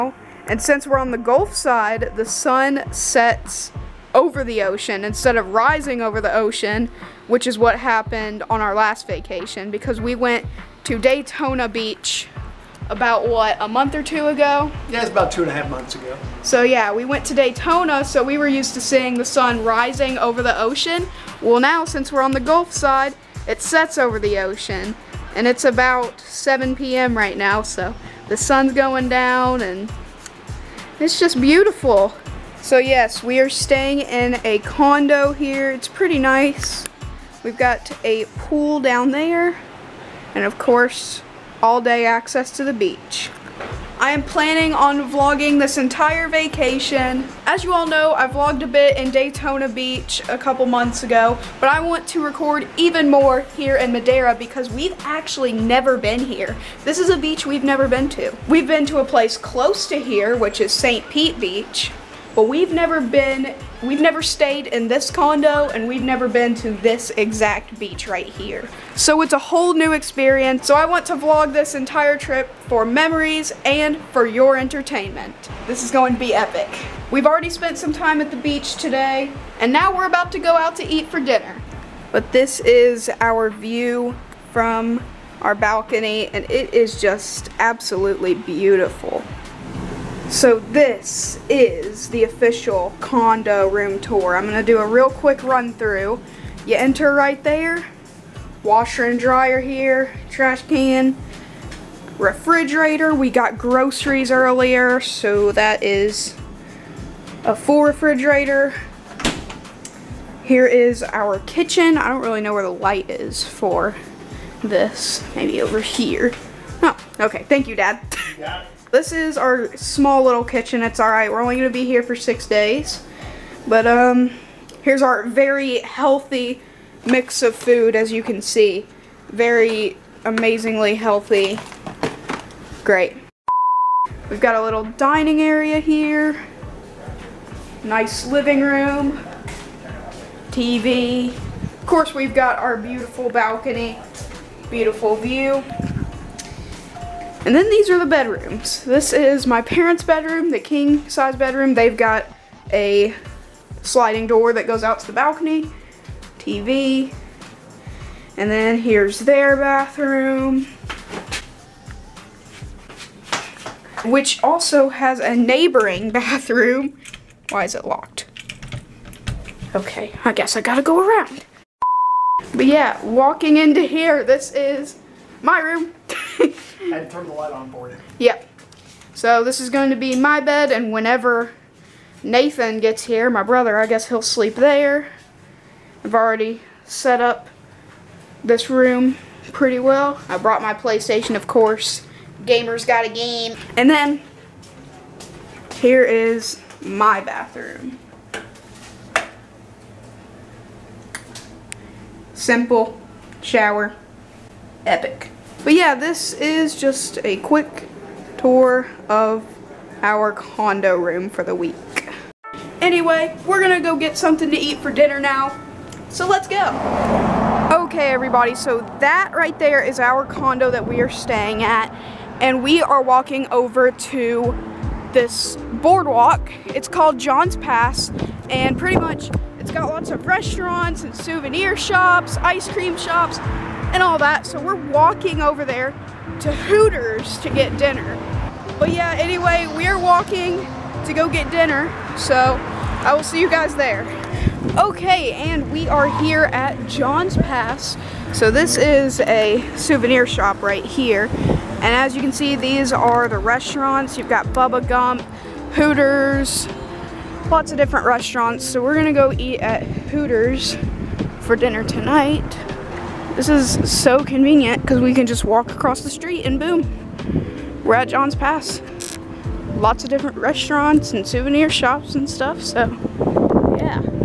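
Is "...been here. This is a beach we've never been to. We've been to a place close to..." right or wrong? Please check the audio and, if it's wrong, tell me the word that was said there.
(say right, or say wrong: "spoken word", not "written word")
right.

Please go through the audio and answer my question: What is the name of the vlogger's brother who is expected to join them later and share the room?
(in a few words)
Nathan.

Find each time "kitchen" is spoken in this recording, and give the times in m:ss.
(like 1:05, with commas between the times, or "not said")
1:51, 2:00.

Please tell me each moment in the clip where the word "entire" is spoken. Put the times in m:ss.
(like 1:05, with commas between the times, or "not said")
0:45, 1:11.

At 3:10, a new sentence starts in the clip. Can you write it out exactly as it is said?
I brought my PlayStation, of course.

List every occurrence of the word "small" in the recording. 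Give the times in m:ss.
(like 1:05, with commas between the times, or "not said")
1:59.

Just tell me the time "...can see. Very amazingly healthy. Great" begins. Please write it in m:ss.
2:08.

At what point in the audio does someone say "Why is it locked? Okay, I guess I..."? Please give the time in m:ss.
2:47.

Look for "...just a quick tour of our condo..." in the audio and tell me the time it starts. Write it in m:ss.
3:26.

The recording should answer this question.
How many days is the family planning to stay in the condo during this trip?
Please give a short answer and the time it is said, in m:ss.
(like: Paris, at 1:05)
6, at 2:02.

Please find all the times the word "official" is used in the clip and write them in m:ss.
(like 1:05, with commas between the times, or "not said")
1:32.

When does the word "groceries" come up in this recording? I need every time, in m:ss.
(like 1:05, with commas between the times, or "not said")
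1:43.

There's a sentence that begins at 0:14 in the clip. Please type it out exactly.
Yeah, it's about two and a half months ago.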